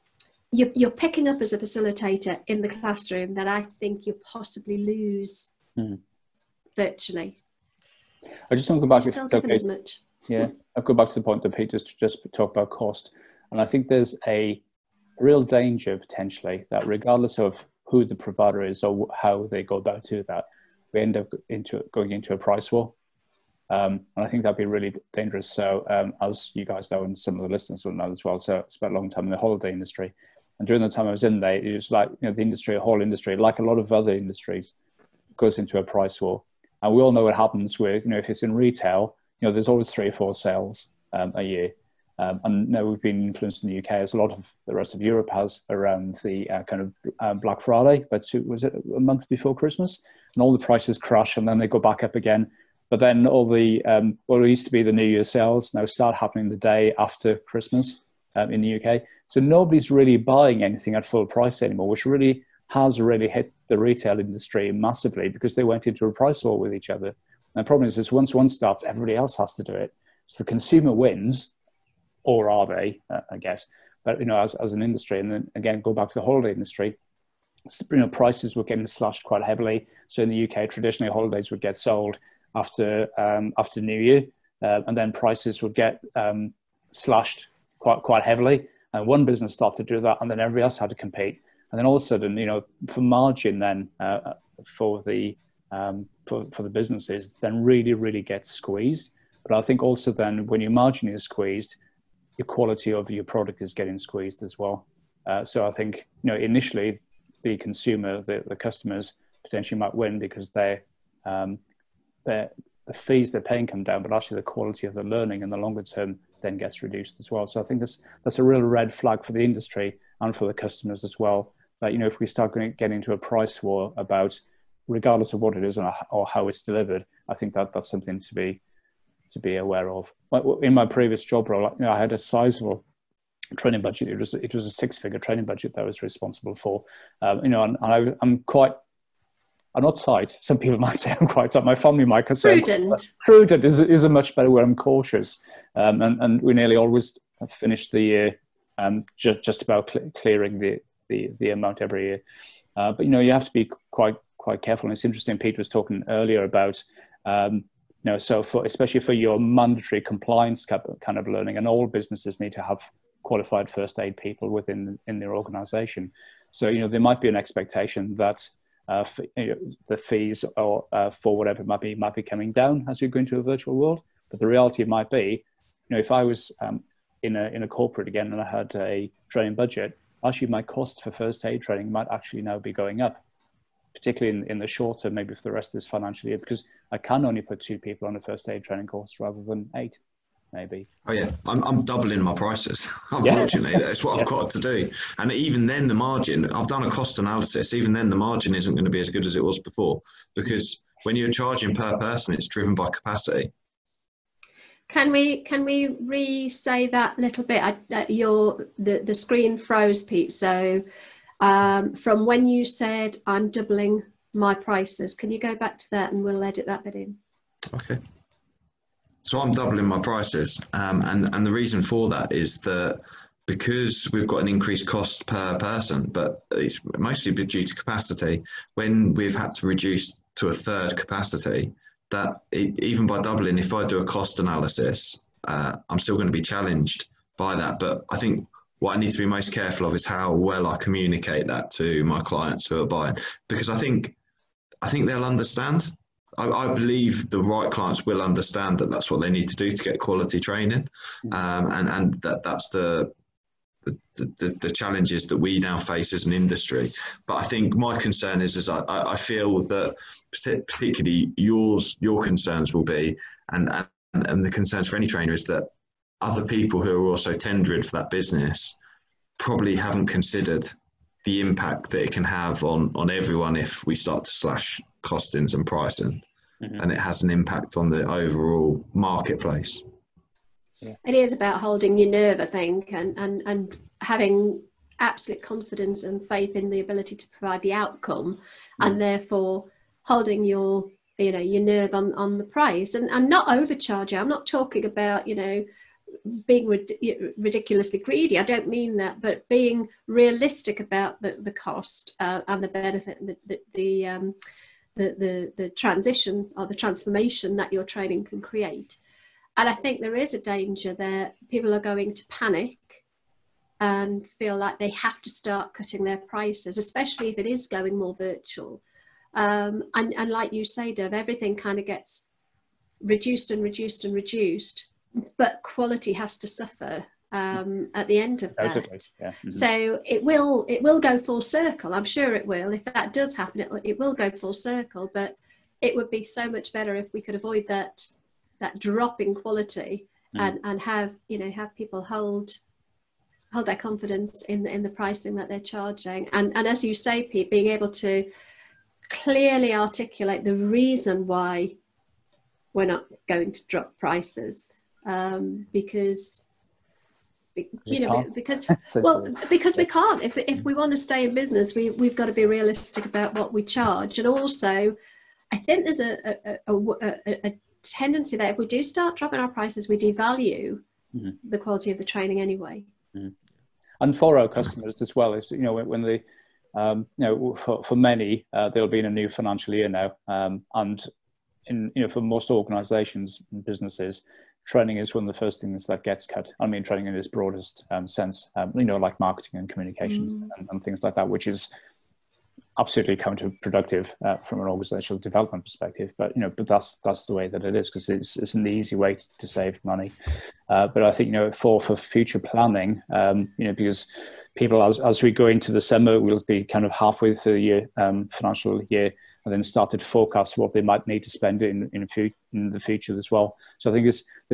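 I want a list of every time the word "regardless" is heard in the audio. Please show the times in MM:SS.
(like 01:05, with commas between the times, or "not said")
00:16, 02:04.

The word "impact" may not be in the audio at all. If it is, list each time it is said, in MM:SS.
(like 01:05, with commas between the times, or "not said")
04:31, 04:37.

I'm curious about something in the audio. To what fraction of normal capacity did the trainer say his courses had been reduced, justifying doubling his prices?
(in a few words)
a third.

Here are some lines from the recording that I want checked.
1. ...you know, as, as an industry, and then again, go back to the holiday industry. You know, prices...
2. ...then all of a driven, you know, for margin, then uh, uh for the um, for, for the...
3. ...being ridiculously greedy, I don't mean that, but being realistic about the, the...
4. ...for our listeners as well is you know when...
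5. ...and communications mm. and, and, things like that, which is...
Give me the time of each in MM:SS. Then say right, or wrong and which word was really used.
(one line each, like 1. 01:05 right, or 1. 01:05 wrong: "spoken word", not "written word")
1. 01:14 right
2. 01:31 wrong: "sudden", not "driven"
3. 04:56 right
4. 06:14 wrong: "customers", not "listeners"
5. 06:29 right.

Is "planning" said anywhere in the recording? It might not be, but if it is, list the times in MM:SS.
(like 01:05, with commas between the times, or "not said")
06:42.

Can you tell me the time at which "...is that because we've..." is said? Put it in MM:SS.
03:42.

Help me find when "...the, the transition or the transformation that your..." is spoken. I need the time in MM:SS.
05:05.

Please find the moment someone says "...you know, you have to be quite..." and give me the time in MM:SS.
02:33.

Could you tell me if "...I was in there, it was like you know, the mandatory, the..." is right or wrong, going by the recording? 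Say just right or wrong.
wrong.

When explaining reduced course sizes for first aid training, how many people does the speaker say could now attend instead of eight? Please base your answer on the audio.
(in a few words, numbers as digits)
2.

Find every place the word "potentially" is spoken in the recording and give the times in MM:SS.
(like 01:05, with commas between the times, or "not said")
00:15, 01:49.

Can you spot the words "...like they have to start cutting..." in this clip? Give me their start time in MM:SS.
05:14.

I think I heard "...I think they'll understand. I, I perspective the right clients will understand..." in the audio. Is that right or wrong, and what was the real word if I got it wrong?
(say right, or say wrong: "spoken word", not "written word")
wrong: "believe", not "perspective".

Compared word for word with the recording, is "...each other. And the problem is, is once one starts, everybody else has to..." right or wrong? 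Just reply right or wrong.
right.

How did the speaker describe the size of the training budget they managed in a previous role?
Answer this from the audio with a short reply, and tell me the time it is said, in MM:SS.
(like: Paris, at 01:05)
six figure, at 02:14.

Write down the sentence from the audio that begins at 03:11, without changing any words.
Oh yeah, I'm, I'm doubling my prices.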